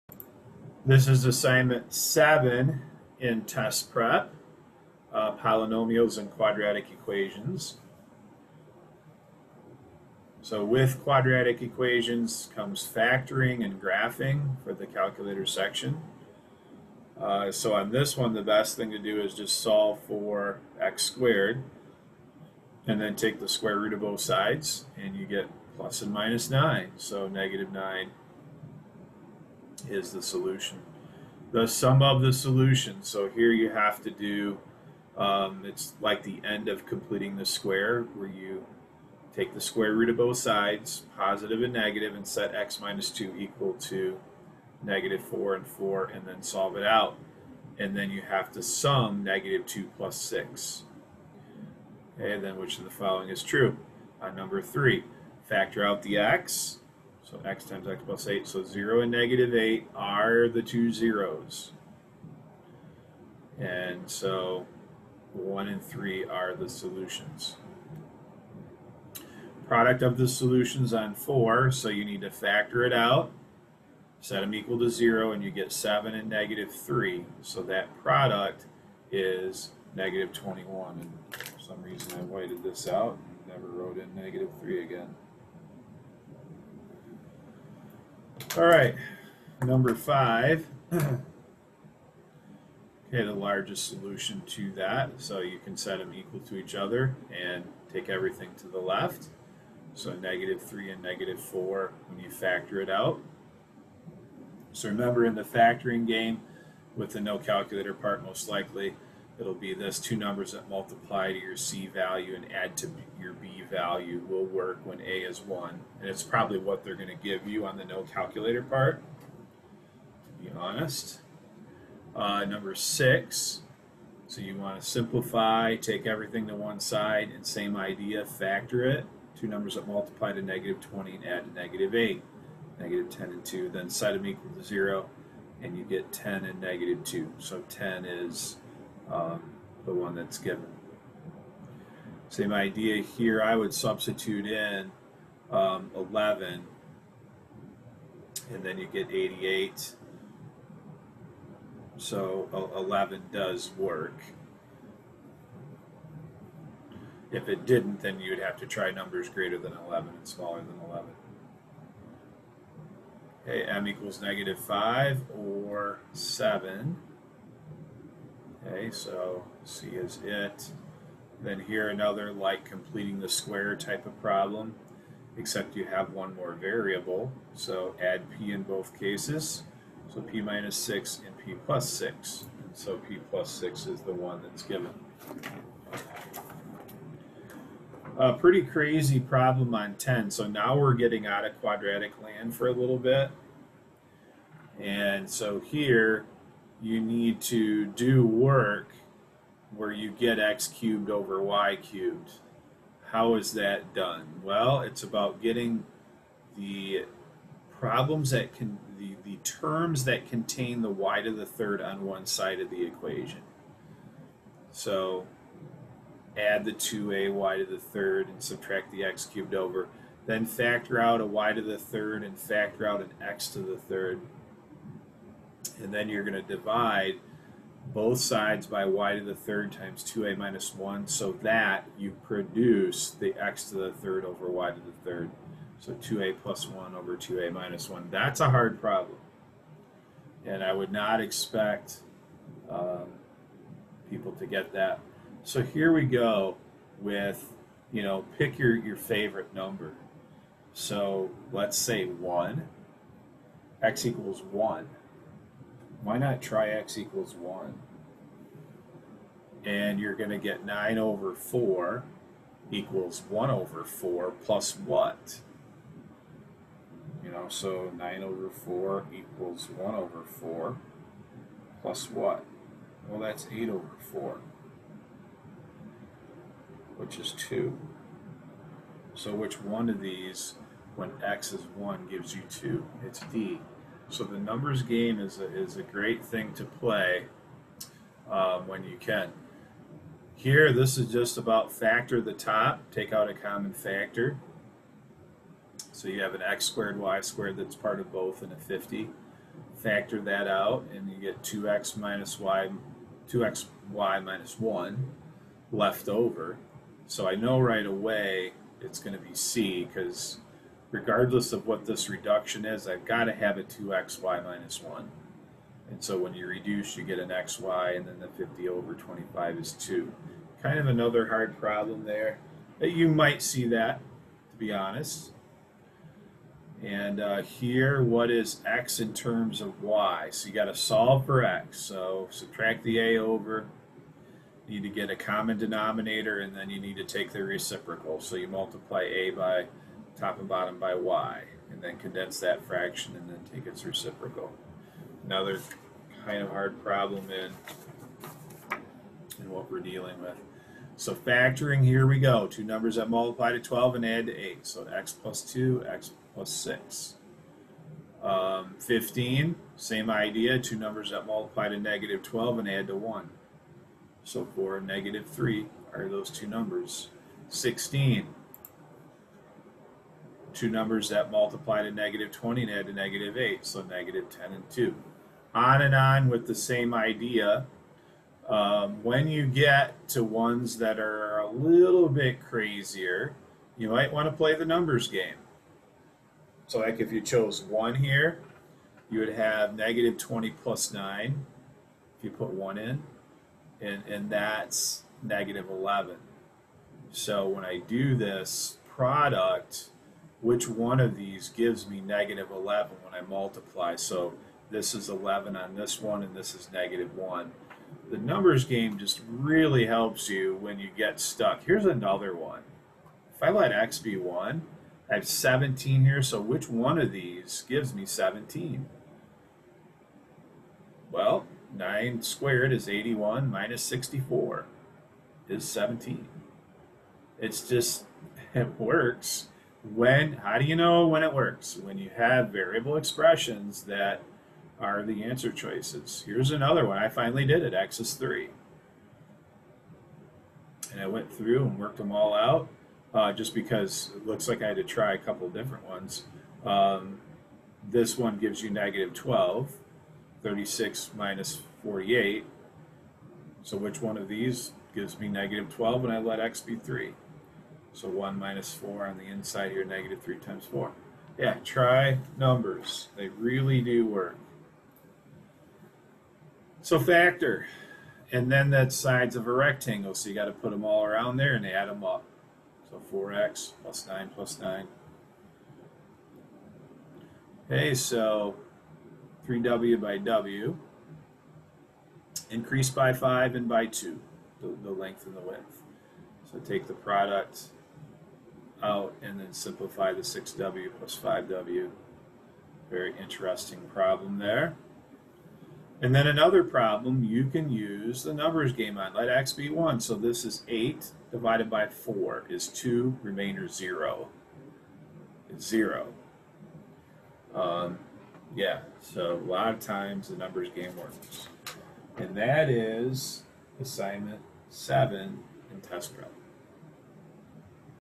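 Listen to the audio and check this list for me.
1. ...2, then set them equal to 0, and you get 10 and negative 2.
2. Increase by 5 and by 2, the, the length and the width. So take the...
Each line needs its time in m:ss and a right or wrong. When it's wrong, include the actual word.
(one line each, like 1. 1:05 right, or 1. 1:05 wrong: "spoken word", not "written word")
1. 2:13 right
2. 8:02 right.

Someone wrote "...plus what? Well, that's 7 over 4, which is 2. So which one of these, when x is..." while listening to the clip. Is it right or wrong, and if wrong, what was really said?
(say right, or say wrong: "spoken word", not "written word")
wrong: "8", not "7".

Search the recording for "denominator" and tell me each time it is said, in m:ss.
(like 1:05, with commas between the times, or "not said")
5:35.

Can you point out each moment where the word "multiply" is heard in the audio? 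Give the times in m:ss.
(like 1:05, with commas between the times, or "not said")
1:50, 2:09, 5:38, 5:53, 6:01, 6:11, 6:43.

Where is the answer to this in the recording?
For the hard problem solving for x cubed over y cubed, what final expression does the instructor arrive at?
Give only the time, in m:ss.
3:55.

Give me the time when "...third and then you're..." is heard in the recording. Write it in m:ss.
3:43.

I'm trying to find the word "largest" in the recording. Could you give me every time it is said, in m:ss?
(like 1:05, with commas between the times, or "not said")
1:33.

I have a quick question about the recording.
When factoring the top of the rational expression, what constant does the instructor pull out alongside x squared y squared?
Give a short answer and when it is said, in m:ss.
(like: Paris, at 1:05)
50, at 4:58.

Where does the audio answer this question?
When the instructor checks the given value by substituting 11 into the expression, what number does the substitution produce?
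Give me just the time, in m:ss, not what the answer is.
2:29.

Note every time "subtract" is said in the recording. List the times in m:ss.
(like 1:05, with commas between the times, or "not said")
3:38, 5:32.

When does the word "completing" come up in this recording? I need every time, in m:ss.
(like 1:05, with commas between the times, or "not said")
0:36, 2:52.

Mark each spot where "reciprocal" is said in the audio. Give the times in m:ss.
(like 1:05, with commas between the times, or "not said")
5:37, 5:43.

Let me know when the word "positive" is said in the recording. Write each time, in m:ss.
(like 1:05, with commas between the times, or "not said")
0:41.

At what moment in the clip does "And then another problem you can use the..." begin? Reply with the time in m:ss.
8:16.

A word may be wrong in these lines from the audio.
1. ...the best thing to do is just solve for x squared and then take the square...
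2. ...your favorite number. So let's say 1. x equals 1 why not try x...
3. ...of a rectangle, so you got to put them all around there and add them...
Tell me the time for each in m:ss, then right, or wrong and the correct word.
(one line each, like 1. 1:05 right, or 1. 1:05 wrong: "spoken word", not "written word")
1. 0:18 right
2. 4:08 right
3. 7:49 right.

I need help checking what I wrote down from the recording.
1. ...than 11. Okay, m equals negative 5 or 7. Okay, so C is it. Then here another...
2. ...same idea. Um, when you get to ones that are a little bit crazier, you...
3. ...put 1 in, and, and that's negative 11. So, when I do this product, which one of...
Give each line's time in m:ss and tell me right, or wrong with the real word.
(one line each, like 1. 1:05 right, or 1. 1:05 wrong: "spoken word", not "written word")
1. 2:40 right
2. 6:16 right
3. 6:32 right.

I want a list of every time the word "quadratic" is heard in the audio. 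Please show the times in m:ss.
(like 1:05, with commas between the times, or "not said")
0:06, 0:11, 3:11.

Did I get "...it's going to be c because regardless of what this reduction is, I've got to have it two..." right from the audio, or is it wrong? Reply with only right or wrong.
right.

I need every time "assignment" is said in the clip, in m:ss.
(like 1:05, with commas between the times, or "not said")
0:01, 8:33.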